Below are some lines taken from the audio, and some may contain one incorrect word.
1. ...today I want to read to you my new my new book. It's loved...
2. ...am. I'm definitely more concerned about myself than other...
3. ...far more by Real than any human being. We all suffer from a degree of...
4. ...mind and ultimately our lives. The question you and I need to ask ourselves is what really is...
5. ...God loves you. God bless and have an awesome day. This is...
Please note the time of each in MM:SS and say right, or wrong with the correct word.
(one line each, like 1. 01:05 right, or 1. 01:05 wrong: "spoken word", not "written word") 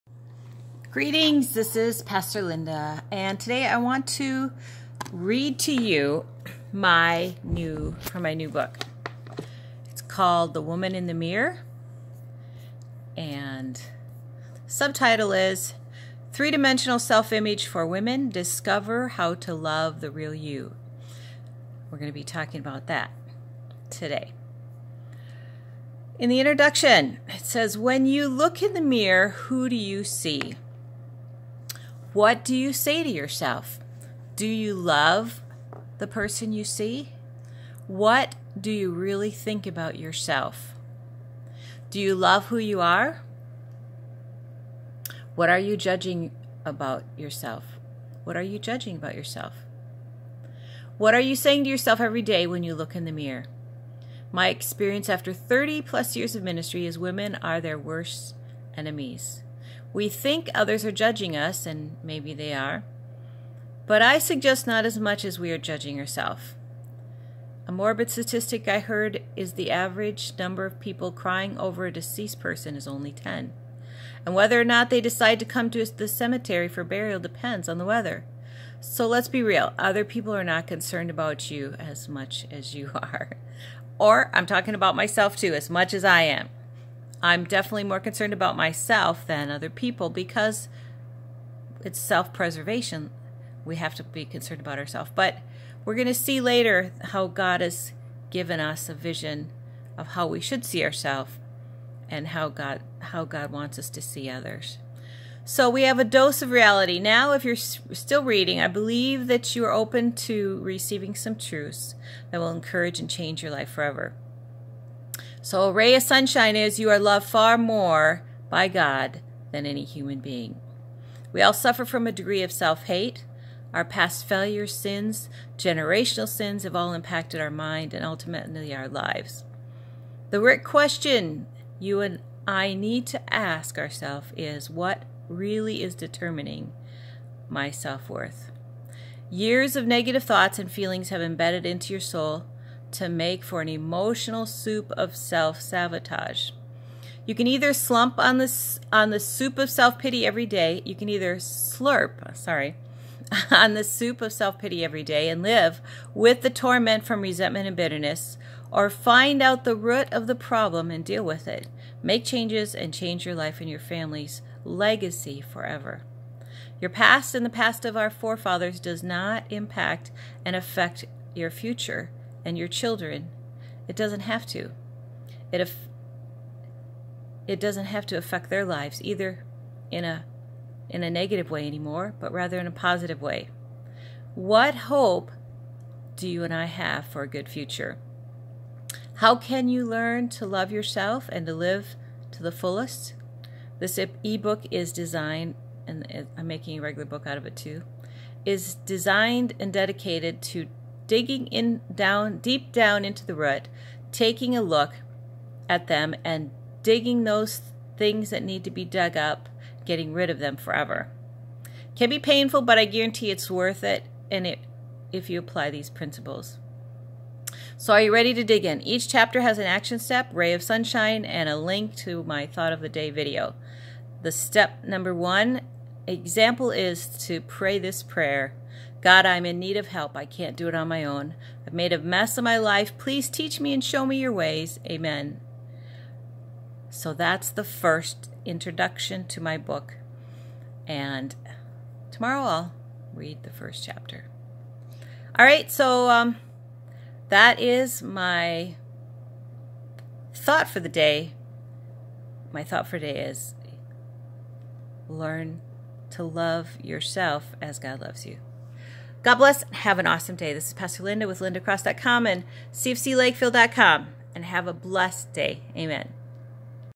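1. 00:03 wrong: "called", not "loved"
2. 01:26 right
3. 01:57 wrong: "God", not "Real"
4. 02:07 right
5. 04:17 right.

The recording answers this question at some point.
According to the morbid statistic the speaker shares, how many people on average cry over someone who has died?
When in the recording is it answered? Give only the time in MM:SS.
01:13.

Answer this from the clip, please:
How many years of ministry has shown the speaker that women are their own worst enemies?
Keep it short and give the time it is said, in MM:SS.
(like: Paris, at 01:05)
30 plus, at 00:55.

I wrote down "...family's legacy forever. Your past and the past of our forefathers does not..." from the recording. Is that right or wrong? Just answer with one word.
right.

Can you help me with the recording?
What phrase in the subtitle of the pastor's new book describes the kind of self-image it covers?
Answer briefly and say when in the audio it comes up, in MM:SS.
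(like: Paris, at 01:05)
Three-Dimensional Self-Image, at 00:16.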